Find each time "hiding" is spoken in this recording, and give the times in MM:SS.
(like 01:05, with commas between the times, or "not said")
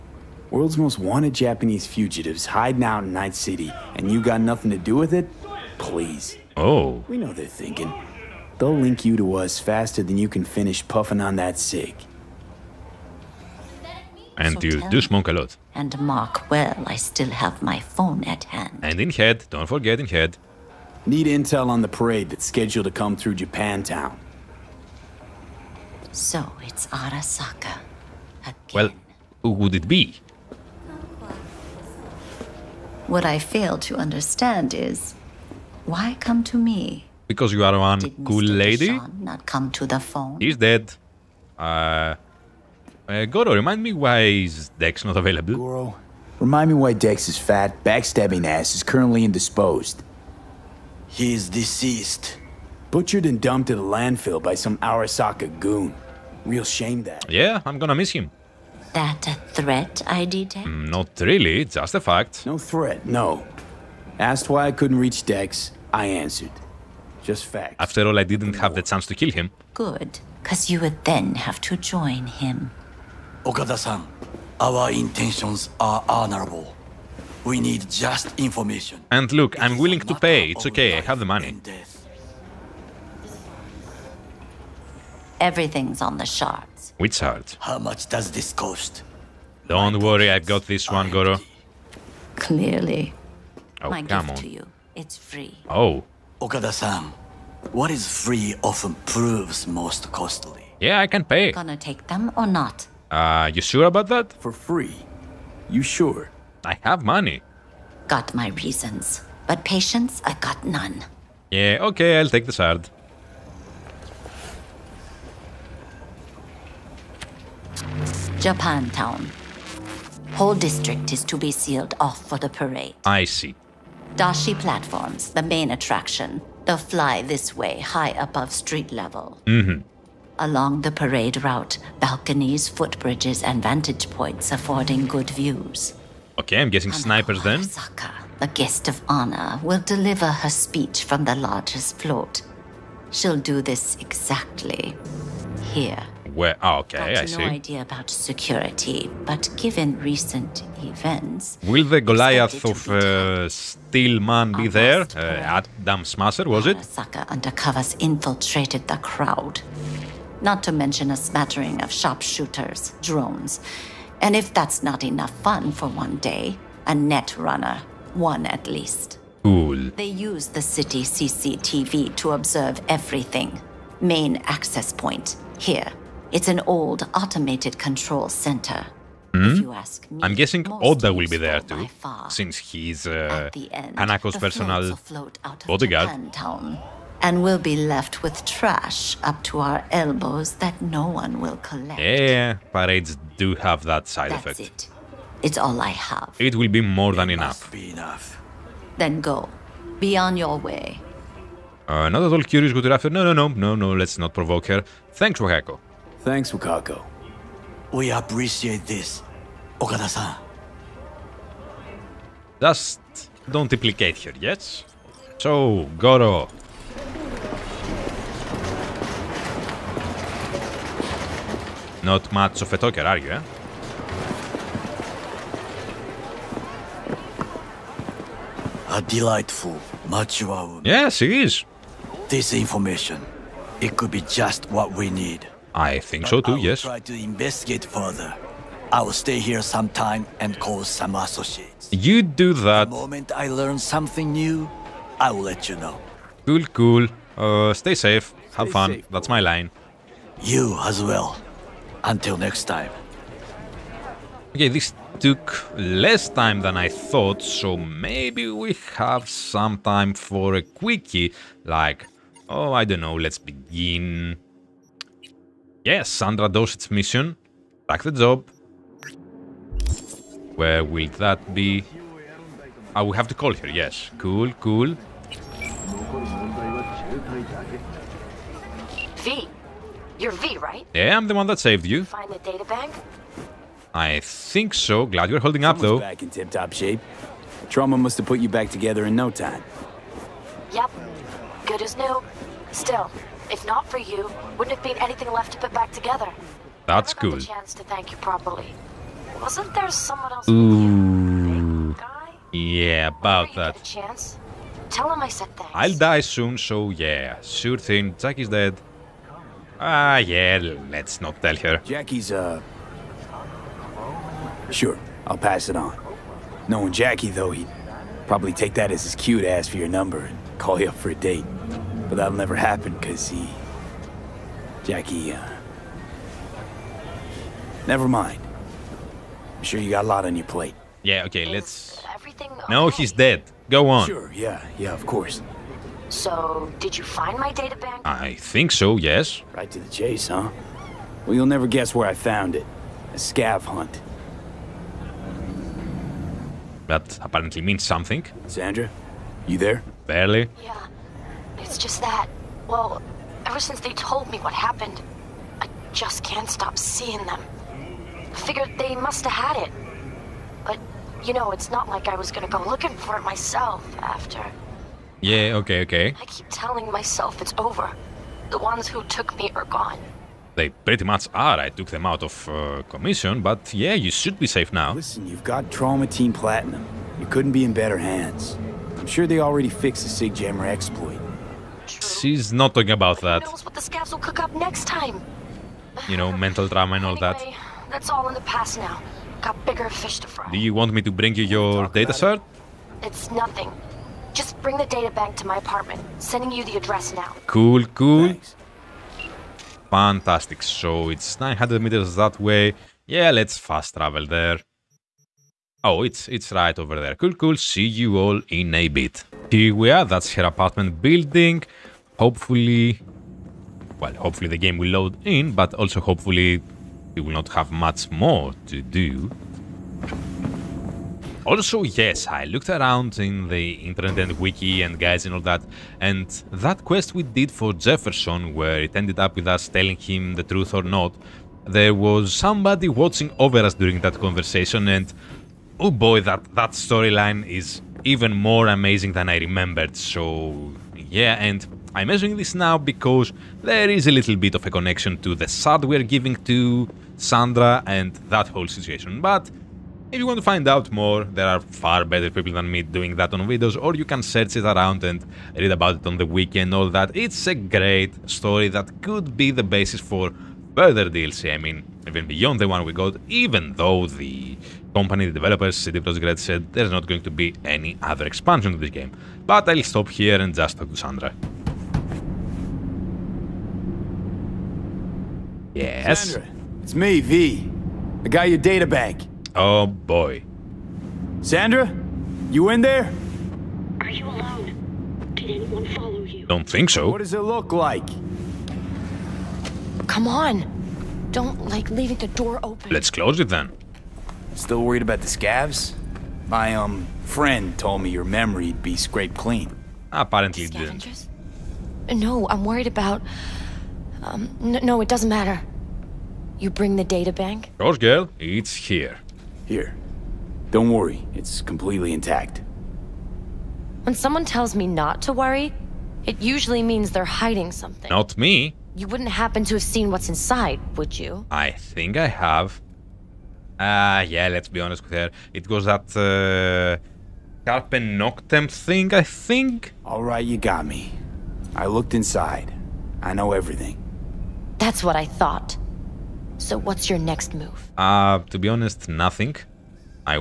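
00:02, 08:37.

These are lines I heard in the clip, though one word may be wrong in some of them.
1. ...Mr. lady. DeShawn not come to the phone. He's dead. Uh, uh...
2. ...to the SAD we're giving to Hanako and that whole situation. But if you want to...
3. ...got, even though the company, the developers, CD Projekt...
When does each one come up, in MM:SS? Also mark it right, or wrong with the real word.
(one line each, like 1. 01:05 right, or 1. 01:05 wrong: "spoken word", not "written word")
1. 00:38 right
2. 07:25 wrong: "Sandra", not "Hanako"
3. 07:42 right.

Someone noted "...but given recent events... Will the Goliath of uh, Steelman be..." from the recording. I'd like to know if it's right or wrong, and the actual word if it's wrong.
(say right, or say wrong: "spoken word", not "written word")
right.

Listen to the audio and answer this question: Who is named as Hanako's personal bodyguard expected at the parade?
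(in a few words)
Oda.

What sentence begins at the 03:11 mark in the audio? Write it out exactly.
Yeah, parades do have that side That's effect.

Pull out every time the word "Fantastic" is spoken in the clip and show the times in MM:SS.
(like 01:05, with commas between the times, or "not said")
06:39.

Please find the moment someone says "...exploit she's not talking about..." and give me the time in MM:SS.
06:20.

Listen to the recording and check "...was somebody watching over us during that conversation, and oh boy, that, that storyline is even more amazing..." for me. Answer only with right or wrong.
right.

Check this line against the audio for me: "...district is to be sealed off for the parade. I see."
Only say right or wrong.
right.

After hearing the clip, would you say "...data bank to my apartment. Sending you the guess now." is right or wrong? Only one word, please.
wrong.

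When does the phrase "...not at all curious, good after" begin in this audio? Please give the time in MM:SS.
03:22.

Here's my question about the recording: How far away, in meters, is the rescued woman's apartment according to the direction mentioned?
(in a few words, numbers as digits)
900.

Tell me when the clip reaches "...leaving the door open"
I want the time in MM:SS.
08:11.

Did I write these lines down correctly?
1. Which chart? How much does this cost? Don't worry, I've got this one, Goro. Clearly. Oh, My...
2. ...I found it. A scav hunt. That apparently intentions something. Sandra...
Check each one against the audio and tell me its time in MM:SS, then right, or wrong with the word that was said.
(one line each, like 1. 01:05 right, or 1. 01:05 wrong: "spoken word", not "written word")
1. 01:26 right
2. 05:42 wrong: "means", not "intentions".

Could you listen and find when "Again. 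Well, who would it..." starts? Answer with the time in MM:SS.
00:28.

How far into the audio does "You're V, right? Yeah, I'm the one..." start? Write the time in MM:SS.
04:40.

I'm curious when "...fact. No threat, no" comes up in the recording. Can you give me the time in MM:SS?
01:01.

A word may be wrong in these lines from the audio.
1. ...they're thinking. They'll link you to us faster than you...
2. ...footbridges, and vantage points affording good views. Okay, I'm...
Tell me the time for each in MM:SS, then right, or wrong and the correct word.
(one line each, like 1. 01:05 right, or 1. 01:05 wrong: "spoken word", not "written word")
1. 00:07 right
2. 02:12 right.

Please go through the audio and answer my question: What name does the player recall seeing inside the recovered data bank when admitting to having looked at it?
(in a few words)
Carpe Noctem.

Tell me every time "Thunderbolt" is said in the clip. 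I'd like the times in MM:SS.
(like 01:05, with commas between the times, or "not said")
not said.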